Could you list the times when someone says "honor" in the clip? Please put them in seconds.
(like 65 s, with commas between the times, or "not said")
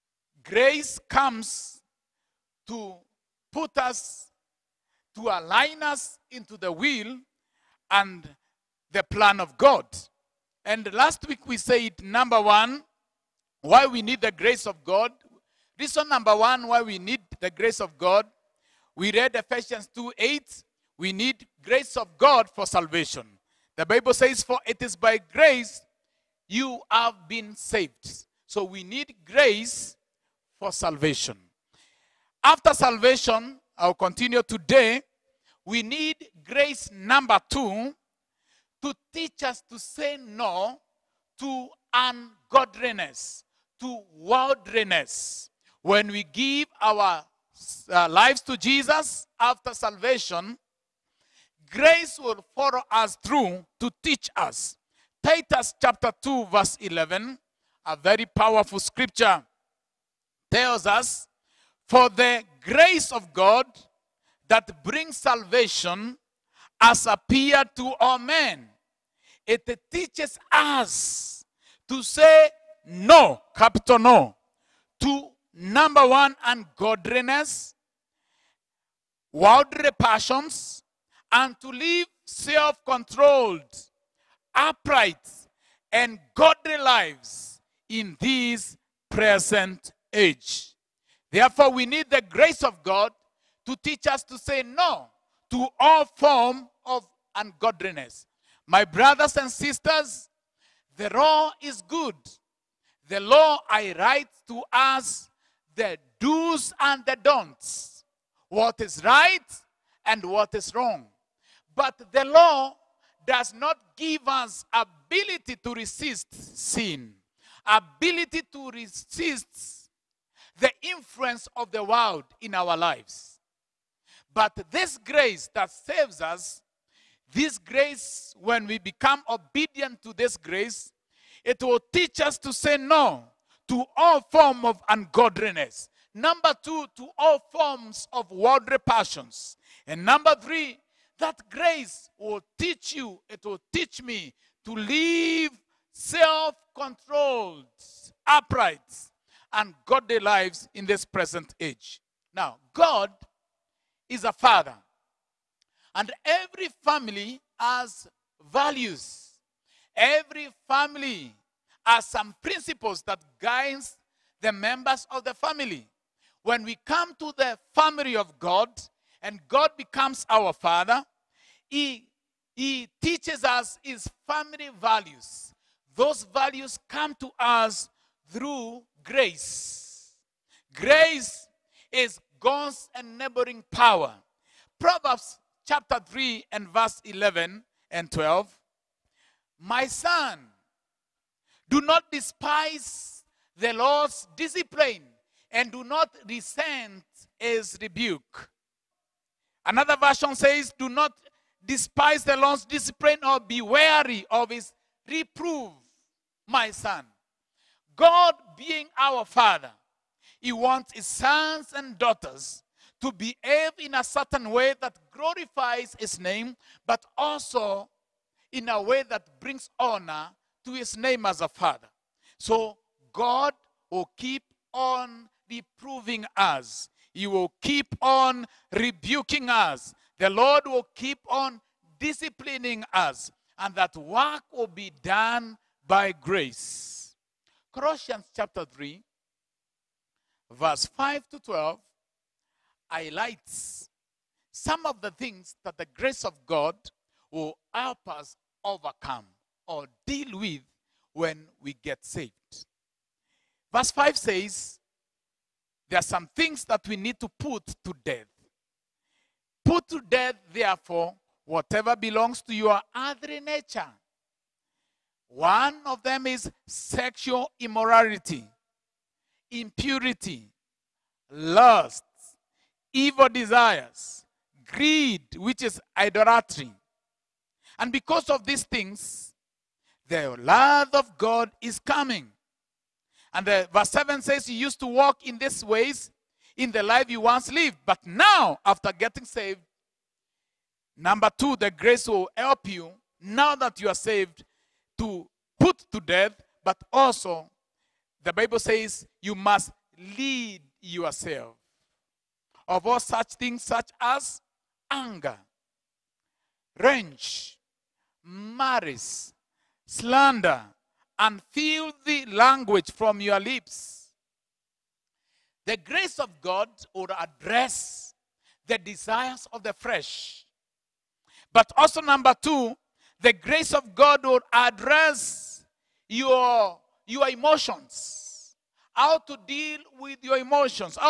219 s.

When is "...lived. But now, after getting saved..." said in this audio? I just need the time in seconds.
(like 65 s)
287 s.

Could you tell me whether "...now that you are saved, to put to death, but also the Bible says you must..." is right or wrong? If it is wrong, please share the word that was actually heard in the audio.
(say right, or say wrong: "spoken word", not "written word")
right.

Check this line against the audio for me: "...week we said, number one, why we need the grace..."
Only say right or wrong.
right.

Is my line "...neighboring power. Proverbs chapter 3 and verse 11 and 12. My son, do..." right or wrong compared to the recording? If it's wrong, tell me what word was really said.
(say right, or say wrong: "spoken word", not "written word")
right.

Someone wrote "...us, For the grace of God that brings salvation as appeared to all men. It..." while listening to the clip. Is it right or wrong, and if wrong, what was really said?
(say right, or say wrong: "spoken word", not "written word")
right.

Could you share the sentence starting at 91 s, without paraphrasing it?
Therefore, we need the grace of God to teach us to say no to all form of ungodliness.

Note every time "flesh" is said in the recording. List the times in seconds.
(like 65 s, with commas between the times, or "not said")
319 s.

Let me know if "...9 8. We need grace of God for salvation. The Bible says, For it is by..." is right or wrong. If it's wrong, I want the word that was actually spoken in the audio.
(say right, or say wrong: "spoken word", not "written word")
wrong: "2", not "9".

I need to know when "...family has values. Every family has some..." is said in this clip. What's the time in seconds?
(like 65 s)
156 s.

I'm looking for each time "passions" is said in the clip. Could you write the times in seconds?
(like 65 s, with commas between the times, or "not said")
79 s, 138 s.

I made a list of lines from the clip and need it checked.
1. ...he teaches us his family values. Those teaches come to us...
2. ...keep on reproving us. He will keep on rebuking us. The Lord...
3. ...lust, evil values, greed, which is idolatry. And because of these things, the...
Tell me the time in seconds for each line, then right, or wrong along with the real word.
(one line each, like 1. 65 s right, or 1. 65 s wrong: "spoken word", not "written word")
1. 172 s wrong: "values", not "teaches"
2. 224 s right
3. 271 s wrong: "desires", not "values".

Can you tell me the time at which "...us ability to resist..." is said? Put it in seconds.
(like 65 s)
114 s.